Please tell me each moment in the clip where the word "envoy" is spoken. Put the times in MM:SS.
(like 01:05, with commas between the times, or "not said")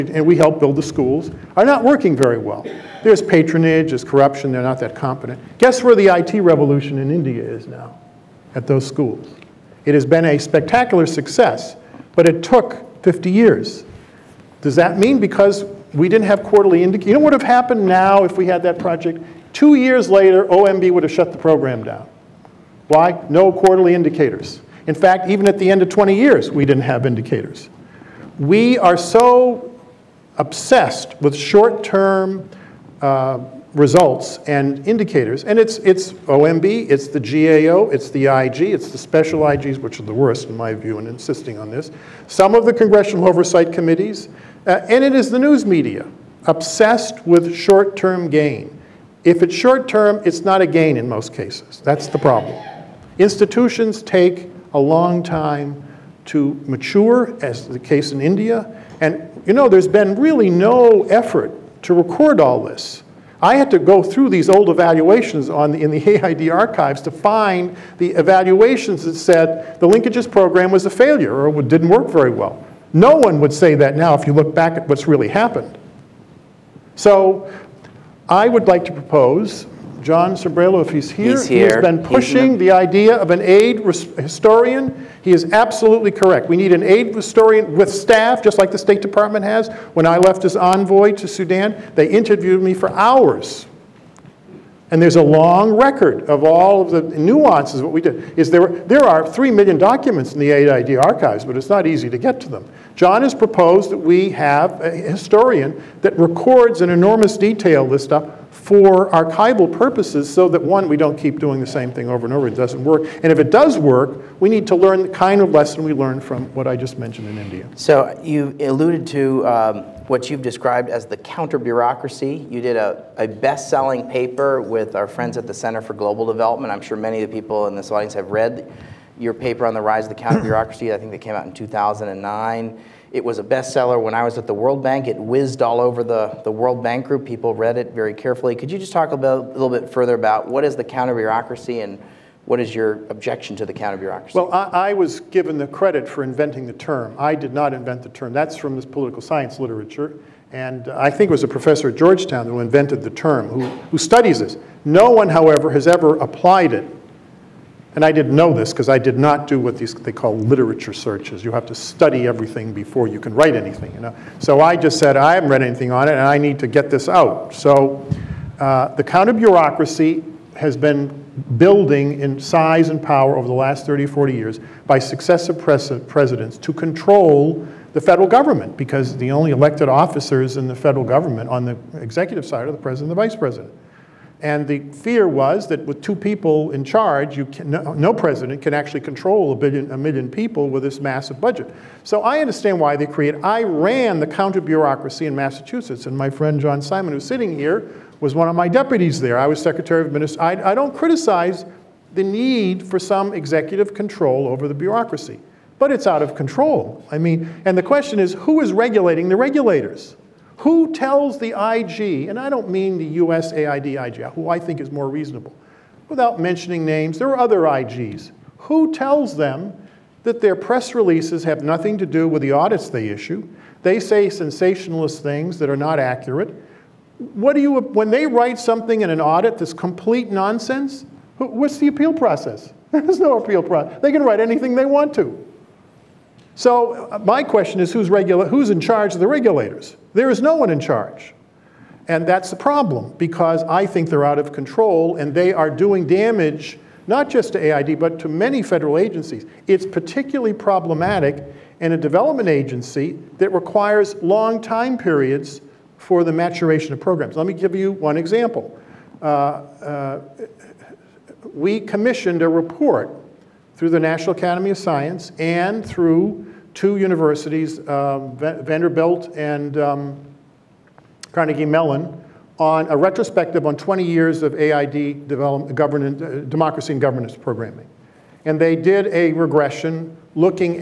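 01:30.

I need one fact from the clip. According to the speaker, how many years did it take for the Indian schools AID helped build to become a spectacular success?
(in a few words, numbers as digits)
50 years.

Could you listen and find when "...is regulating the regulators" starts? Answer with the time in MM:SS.
03:28.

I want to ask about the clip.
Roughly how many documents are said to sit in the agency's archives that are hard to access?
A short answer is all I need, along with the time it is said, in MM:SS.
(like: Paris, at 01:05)
3 million, at 01:39.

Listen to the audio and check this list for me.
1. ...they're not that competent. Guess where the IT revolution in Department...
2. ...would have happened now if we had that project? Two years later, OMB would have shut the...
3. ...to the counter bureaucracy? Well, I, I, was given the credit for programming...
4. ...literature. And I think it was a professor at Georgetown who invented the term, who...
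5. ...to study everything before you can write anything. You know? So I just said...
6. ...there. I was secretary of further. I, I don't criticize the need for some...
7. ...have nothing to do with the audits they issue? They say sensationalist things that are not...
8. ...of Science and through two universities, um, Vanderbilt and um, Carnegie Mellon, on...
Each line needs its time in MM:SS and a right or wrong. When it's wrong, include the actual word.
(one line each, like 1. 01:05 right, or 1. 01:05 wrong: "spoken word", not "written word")
1. 00:04 wrong: "India", not "Department"
2. 00:17 right
3. 02:23 wrong: "inventing", not "programming"
4. 02:29 right
5. 02:41 right
6. 03:19 wrong: "minister", not "further"
7. 03:41 right
8. 04:24 right.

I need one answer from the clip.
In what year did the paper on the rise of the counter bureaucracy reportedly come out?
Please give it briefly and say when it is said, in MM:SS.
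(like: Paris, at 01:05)
2009, at 02:11.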